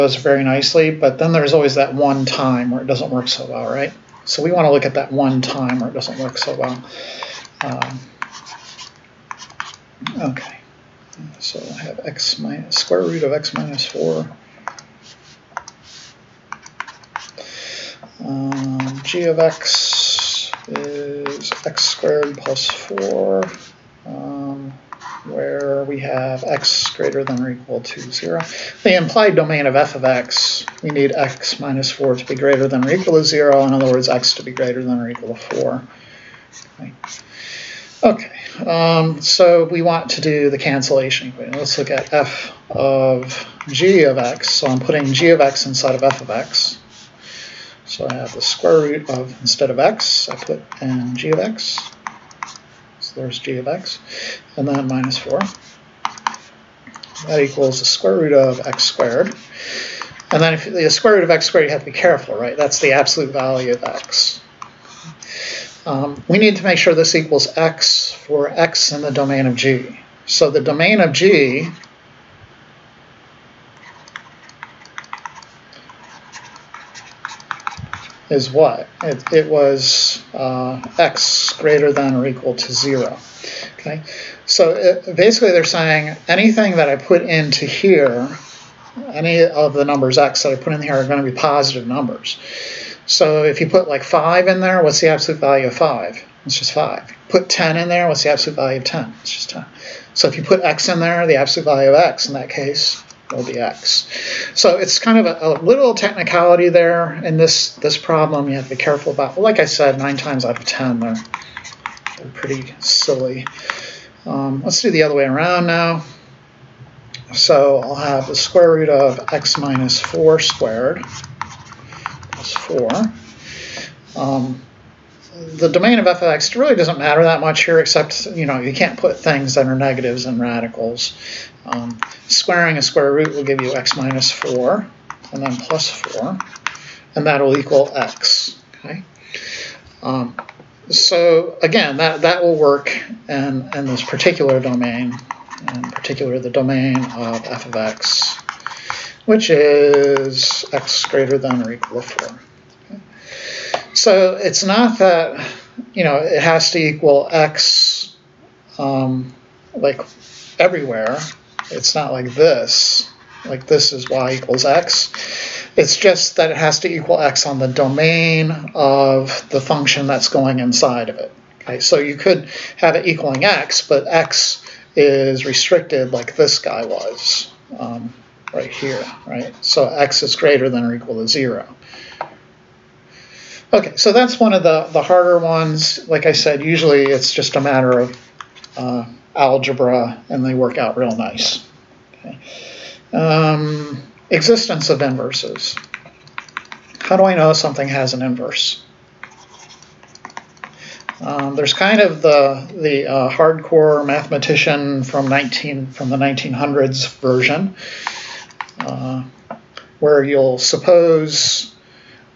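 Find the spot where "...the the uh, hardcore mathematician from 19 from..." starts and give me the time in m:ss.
3:22.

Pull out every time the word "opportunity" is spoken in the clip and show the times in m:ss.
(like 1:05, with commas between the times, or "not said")
not said.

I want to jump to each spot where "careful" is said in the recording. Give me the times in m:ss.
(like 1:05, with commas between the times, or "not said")
1:01, 1:48.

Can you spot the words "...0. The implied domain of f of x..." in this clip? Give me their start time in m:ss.
0:27.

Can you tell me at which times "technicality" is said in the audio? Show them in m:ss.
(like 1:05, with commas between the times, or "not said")
1:45.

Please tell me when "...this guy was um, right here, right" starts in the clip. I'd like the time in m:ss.
2:56.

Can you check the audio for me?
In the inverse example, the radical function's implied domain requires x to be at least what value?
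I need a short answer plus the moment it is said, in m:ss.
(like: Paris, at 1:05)
4, at 0:34.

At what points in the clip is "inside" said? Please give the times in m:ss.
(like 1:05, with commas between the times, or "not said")
0:45, 2:50.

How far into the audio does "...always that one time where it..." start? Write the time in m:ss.
0:01.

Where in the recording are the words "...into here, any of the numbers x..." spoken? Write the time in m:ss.
1:27.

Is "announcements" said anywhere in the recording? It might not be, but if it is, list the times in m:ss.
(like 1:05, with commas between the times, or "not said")
not said.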